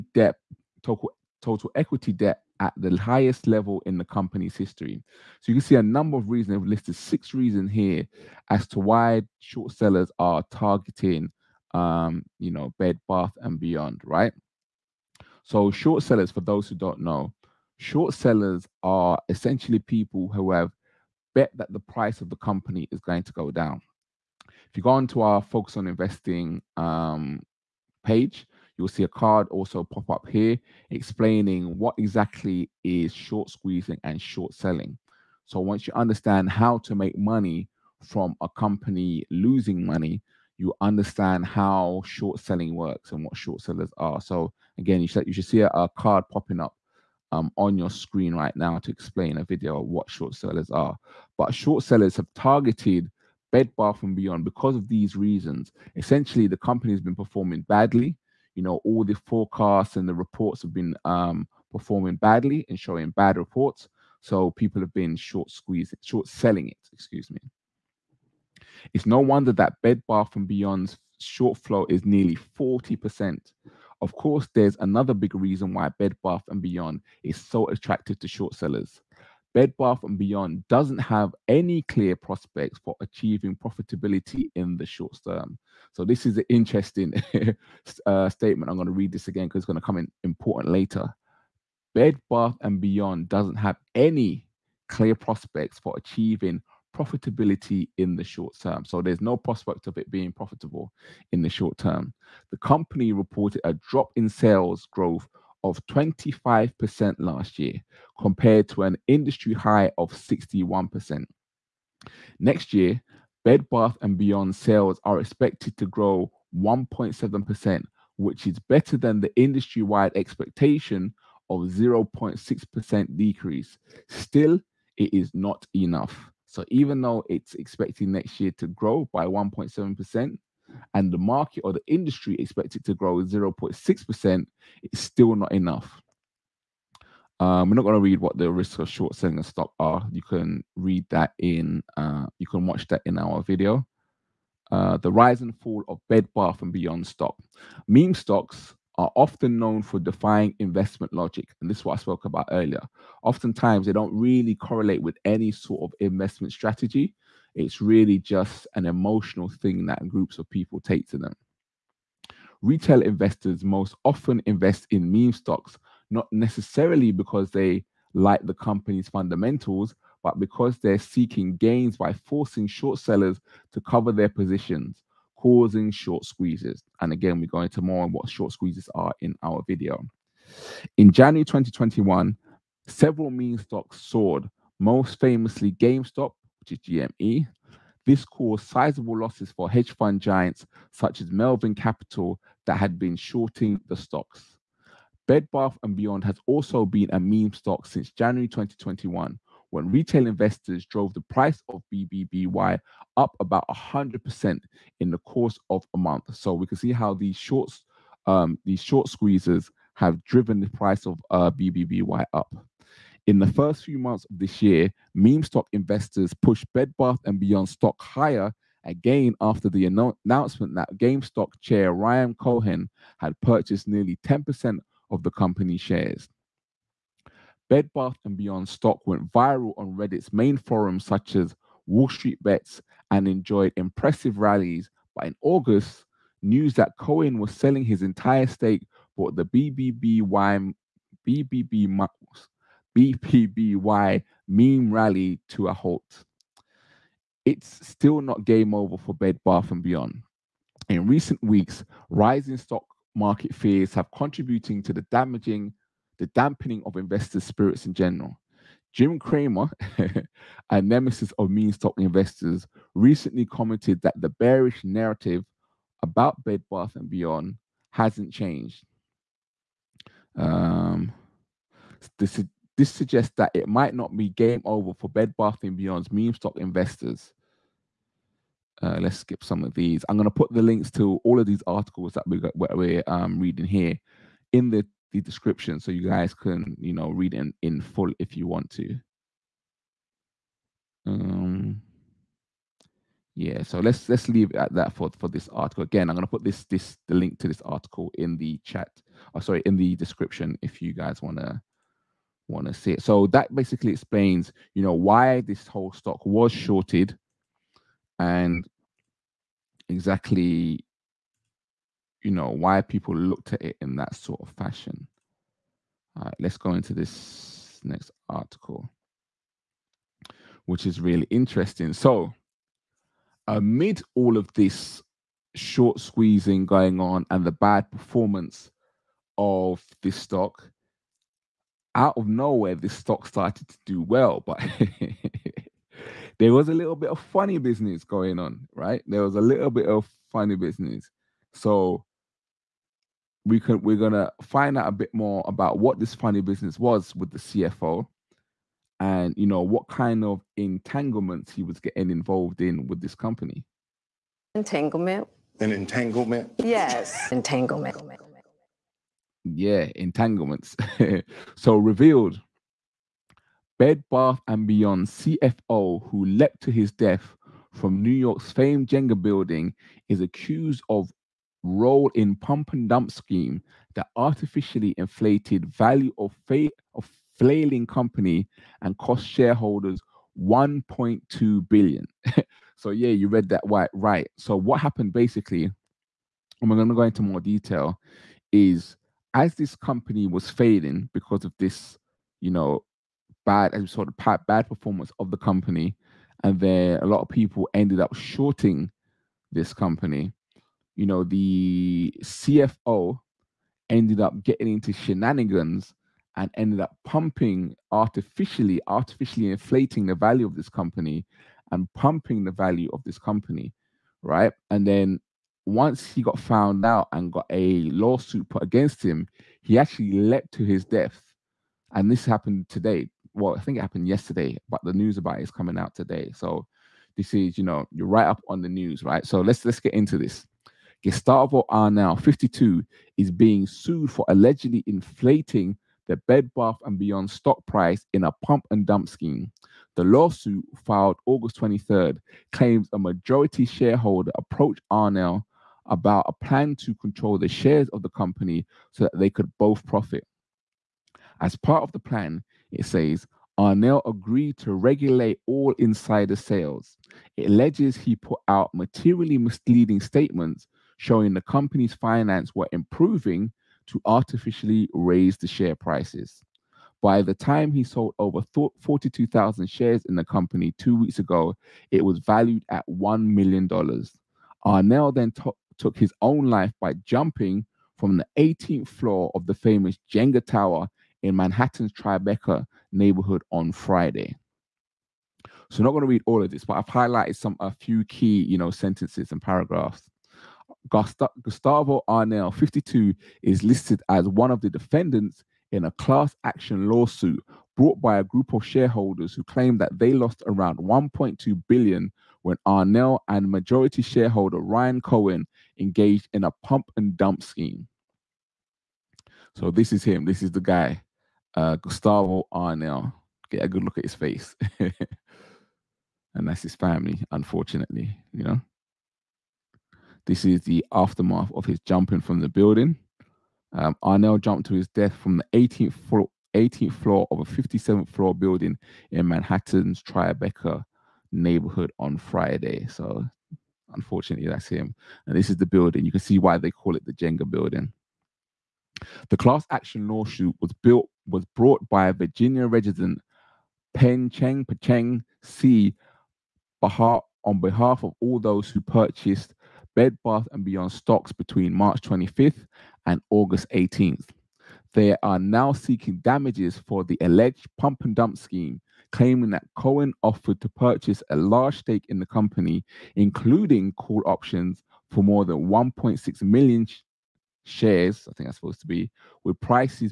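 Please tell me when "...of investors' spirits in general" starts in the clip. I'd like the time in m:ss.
4:16.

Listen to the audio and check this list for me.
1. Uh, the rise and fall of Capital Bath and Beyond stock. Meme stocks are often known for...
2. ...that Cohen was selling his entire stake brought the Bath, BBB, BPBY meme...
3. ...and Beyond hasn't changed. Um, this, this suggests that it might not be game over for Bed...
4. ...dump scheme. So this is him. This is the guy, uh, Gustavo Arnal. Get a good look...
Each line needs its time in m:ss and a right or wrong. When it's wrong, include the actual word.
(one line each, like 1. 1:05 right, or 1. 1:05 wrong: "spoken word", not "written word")
1. 2:24 wrong: "Bed", not "Capital"
2. 3:56 wrong: "BBBY", not "Bath"
3. 4:26 right
4. 8:27 right.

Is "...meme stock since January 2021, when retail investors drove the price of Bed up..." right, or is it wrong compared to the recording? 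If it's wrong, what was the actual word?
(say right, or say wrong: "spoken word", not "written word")
wrong: "BBBY", not "Bed".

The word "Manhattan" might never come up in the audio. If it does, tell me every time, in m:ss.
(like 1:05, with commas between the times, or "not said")
8:01, 8:49.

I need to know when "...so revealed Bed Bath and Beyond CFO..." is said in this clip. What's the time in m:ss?
6:01.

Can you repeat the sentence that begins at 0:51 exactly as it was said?
But short sellers have targeted Bed Bath and Beyond because of these reasons.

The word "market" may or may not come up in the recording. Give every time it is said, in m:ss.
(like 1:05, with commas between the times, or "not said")
2:11, 4:13.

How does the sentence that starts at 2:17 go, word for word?
Um, we're not going to read what the risks of short selling a stock are.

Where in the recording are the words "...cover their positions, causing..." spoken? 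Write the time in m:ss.
2:53.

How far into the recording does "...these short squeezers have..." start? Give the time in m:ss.
3:28.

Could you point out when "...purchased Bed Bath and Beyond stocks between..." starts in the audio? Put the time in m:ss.
9:08.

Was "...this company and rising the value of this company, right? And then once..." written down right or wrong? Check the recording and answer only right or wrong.
wrong.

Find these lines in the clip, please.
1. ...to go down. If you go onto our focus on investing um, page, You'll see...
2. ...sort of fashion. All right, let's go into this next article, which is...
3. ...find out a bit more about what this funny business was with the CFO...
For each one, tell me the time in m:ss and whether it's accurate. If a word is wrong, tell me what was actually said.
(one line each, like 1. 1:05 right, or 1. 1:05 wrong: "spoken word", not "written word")
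1. 0:23 right
2. 5:14 right
3. 5:44 right.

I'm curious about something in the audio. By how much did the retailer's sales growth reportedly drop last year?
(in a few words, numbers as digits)
25%.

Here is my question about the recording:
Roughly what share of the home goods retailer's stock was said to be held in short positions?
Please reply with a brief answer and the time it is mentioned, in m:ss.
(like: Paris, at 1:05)
nearly 40%, at 1:12.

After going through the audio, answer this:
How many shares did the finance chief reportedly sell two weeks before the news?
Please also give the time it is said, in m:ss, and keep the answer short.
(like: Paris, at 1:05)
42,000, at 7:48.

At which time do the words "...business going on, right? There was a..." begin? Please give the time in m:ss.
5:37.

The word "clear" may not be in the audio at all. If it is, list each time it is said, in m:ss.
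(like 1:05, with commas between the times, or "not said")
1:21, 1:34.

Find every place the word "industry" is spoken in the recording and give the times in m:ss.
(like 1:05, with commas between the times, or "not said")
1:49, 1:59, 2:11.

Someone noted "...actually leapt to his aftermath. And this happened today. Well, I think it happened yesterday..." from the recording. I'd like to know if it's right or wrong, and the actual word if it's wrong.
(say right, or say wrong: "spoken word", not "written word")
wrong: "death", not "aftermath".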